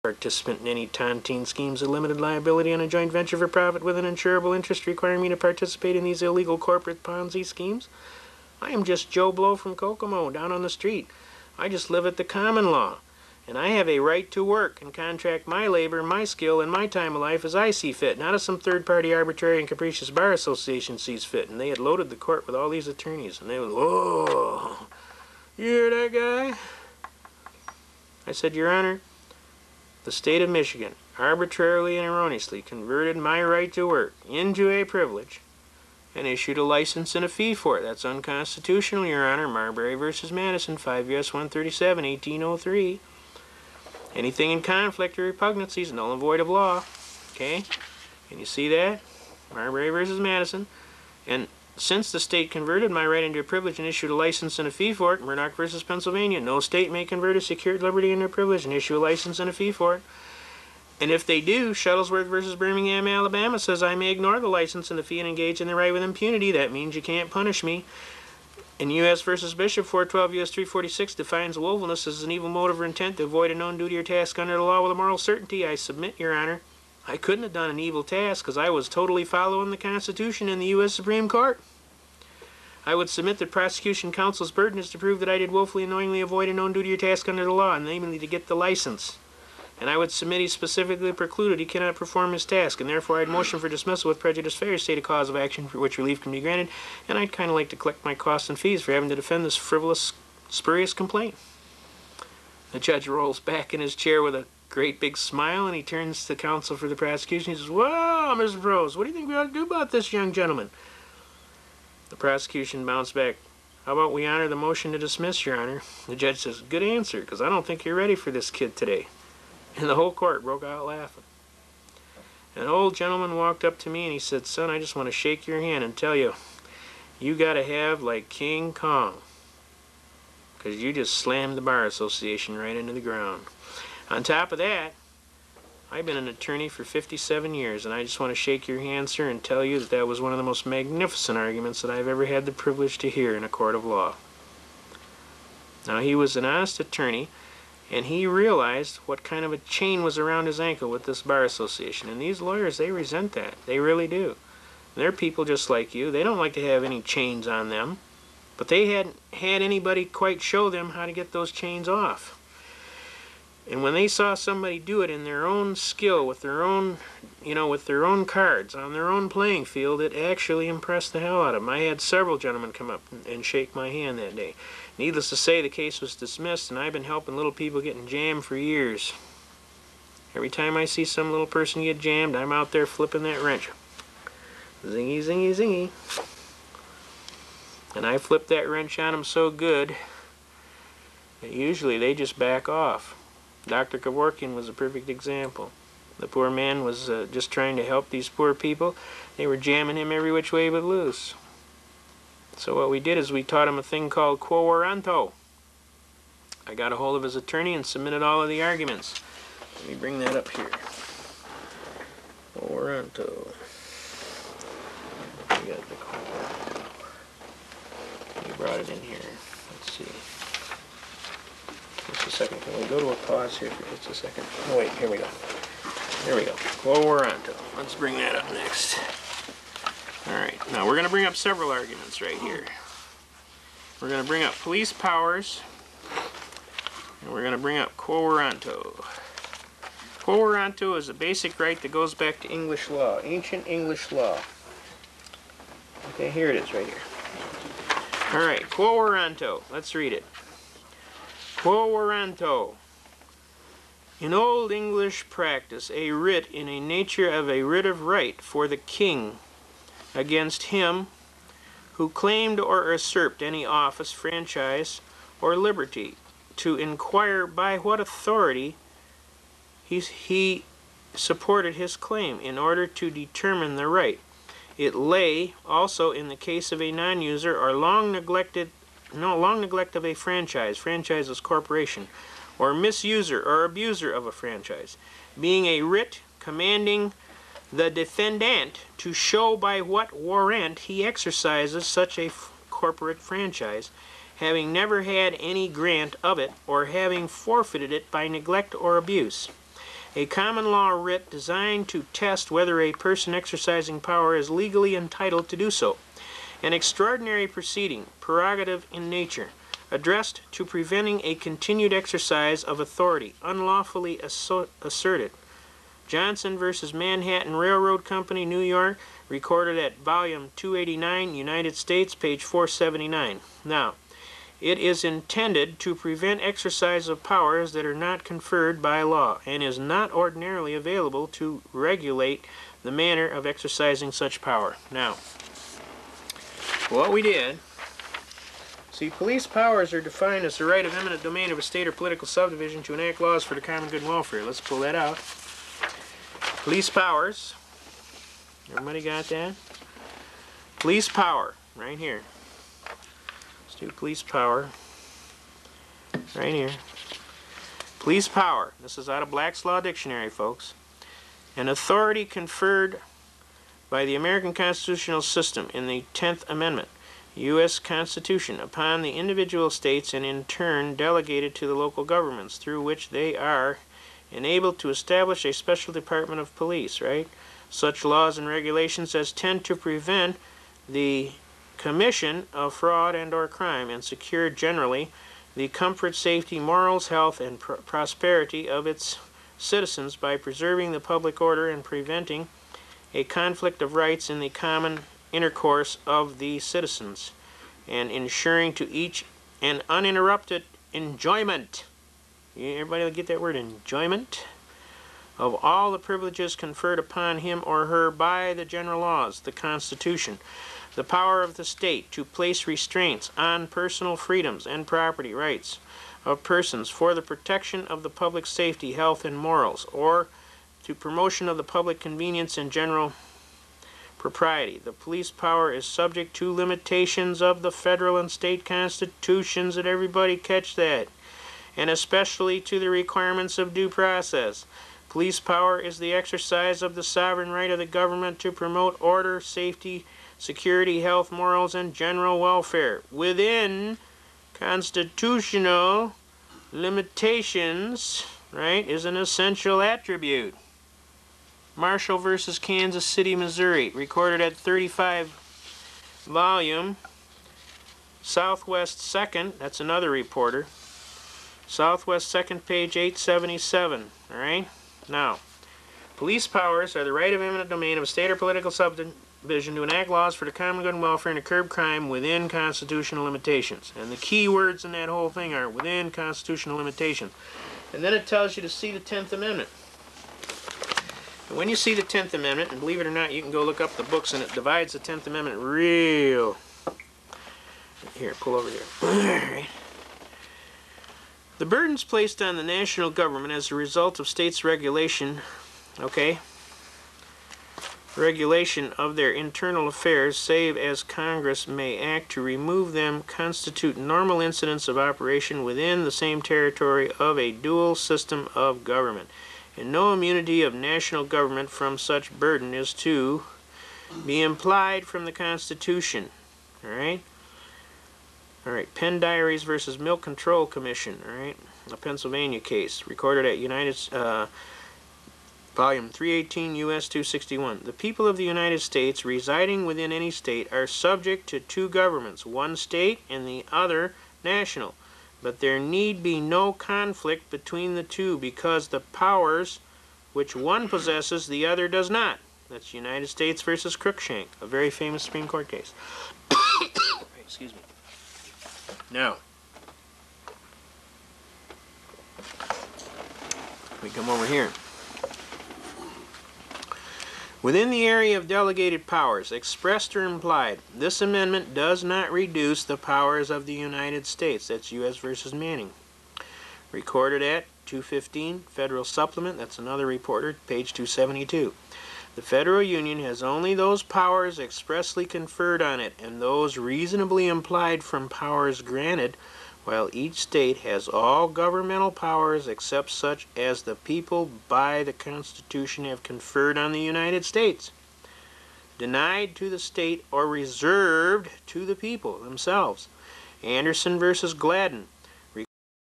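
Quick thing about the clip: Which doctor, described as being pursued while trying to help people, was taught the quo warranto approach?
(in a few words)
Dr. Kevorkian.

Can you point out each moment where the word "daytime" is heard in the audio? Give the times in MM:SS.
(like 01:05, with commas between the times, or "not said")
not said.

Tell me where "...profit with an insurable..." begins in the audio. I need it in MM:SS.
00:03.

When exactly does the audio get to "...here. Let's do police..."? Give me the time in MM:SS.
05:51.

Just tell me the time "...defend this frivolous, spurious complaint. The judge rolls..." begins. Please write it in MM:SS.
01:39.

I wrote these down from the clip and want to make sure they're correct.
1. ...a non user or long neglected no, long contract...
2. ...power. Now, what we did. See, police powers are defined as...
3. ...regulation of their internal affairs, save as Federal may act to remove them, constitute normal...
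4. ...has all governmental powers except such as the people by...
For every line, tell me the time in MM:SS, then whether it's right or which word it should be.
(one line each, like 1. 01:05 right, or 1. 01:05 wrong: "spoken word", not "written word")
1. 04:36 wrong: "neglect", not "contract"
2. 05:34 right
3. 08:18 wrong: "Congress", not "Federal"
4. 09:40 right.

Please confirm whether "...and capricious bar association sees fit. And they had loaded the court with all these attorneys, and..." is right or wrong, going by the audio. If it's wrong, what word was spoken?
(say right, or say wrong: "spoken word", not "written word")
right.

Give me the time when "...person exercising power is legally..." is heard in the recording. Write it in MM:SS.
05:02.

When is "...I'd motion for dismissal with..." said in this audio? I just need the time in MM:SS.
01:33.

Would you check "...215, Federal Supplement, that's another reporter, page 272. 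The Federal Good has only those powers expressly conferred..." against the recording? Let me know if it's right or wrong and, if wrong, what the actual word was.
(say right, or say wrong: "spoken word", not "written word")
wrong: "Union", not "Good".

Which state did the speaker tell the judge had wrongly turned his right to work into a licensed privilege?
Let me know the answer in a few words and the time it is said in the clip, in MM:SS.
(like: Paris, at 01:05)
Michigan, at 00:30.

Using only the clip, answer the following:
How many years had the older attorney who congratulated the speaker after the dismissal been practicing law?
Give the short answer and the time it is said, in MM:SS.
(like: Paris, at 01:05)
57, at 02:16.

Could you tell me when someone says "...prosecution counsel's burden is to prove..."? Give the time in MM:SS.
01:23.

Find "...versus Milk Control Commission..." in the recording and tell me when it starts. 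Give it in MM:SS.
08:39.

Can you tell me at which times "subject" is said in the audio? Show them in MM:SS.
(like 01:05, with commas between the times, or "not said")
07:05, 08:50.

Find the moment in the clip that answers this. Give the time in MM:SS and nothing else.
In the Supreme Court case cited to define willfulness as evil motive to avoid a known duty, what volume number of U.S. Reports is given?
01:09.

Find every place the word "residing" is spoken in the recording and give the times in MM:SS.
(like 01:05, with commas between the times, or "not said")
08:49.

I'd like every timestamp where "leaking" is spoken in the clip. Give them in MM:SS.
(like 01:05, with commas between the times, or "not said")
not said.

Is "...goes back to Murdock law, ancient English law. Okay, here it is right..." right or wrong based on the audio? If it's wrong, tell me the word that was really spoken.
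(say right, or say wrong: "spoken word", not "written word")
wrong: "English", not "Murdock".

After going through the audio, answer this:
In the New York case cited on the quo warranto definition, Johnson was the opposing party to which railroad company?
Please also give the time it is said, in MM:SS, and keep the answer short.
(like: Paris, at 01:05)
Manhattan Railroad Company, at 05:16.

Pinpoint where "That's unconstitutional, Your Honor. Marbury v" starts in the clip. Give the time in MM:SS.
00:37.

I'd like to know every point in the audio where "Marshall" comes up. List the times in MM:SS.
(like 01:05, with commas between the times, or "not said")
07:31.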